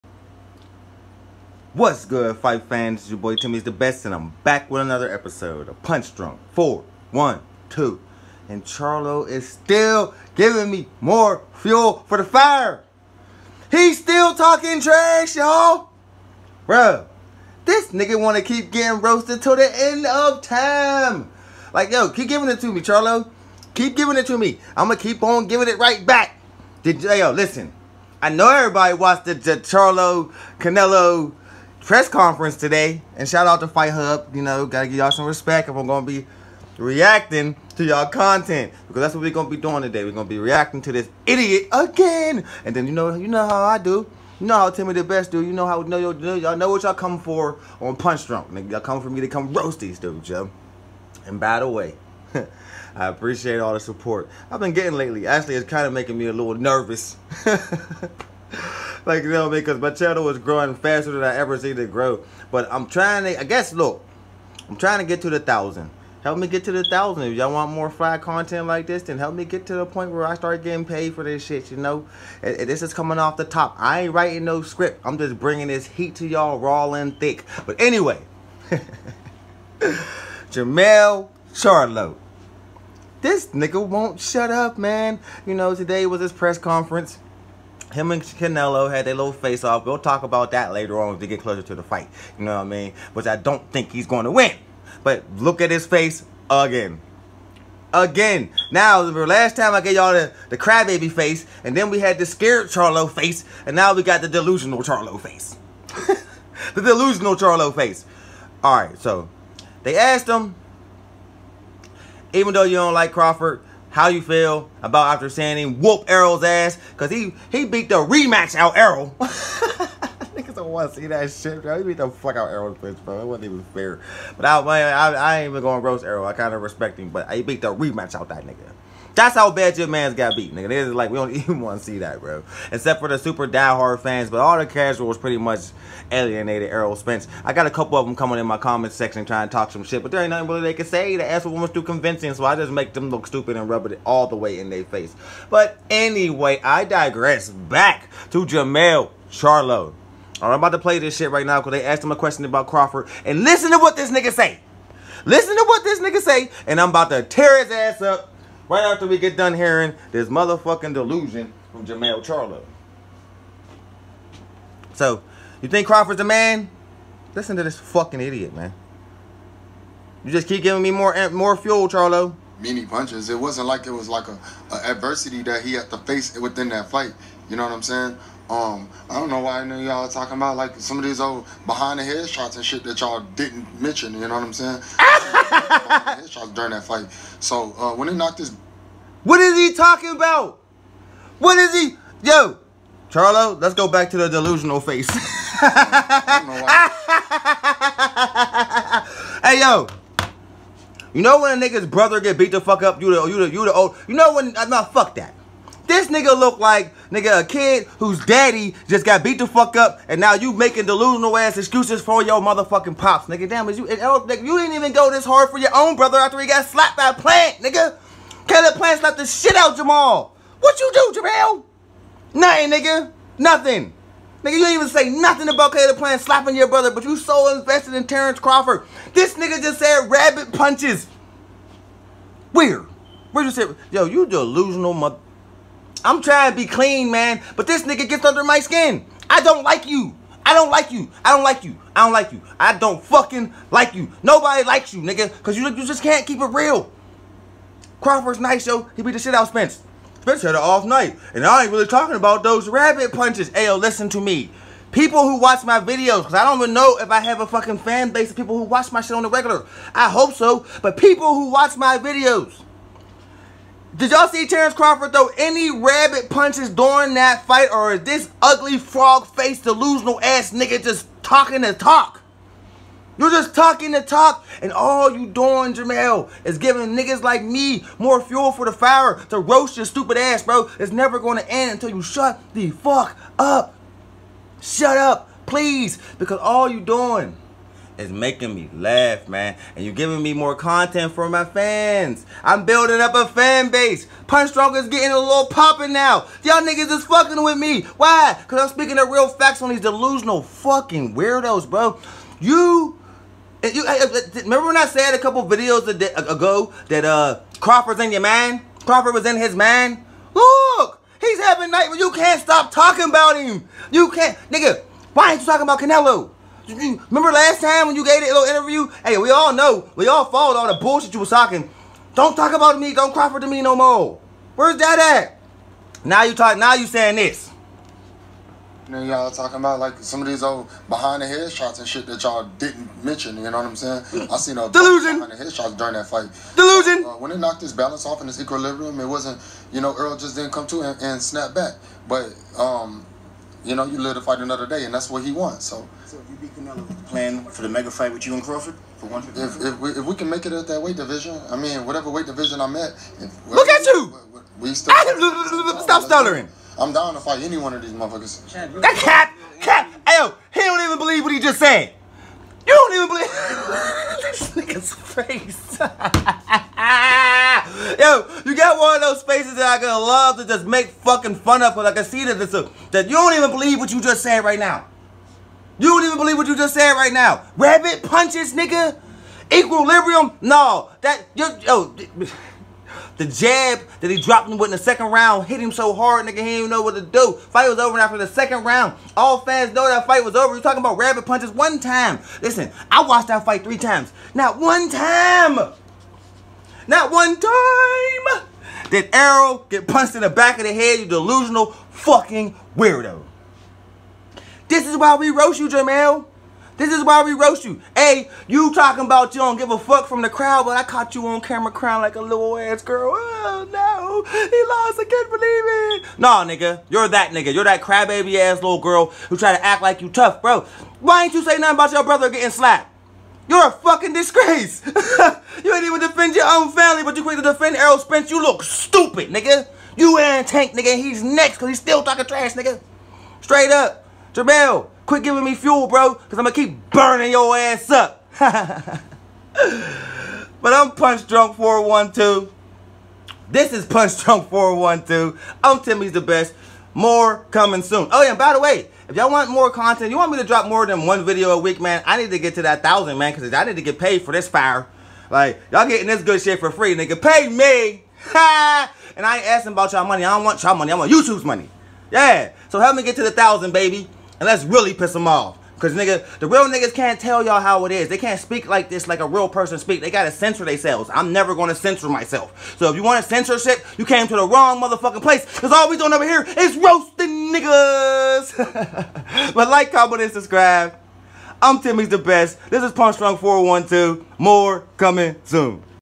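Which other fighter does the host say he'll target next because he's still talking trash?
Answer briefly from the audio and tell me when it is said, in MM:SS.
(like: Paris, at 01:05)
Tank, at 07:10.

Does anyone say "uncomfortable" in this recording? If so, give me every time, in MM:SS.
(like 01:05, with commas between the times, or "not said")
not said.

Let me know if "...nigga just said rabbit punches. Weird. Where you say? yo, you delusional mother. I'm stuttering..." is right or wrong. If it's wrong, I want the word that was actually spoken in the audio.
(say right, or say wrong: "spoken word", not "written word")
wrong: "trying", not "stuttering".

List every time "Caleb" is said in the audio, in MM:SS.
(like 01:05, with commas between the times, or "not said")
03:38, 03:45.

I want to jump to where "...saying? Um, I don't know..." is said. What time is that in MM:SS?
02:57.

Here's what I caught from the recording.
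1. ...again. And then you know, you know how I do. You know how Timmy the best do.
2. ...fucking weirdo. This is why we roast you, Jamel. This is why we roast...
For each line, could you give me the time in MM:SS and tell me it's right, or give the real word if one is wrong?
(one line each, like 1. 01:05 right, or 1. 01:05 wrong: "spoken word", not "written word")
1. 00:41 right
2. 06:41 right.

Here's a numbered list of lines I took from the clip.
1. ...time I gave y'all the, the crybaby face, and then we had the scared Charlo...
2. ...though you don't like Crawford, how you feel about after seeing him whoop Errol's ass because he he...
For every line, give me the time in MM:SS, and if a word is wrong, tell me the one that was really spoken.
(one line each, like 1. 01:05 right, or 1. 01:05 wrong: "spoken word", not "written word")
1. 01:39 right
2. 01:52 right.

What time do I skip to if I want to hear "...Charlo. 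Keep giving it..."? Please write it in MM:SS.
00:22.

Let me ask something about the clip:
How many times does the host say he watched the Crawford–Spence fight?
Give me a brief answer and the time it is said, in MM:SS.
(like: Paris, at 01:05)
3, at 06:33.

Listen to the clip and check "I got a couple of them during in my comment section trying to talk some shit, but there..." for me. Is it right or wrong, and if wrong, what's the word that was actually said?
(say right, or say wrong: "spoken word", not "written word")
wrong: "coming", not "during".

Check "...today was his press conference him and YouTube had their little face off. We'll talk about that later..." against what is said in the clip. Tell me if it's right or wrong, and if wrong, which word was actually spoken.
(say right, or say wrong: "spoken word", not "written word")
wrong: "Canelo", not "YouTube".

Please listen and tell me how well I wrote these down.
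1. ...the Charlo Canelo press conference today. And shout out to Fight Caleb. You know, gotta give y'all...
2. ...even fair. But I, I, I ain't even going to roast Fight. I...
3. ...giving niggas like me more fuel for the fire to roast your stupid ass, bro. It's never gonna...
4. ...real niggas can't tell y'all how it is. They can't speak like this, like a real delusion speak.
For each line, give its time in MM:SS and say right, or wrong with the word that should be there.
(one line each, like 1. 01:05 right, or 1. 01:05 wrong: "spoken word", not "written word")
1. 00:29 wrong: "Hub", not "Caleb"
2. 02:03 wrong: "Errol", not "Fight"
3. 04:36 right
4. 07:46 wrong: "person", not "delusion".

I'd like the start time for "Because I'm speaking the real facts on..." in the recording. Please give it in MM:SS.
04:58.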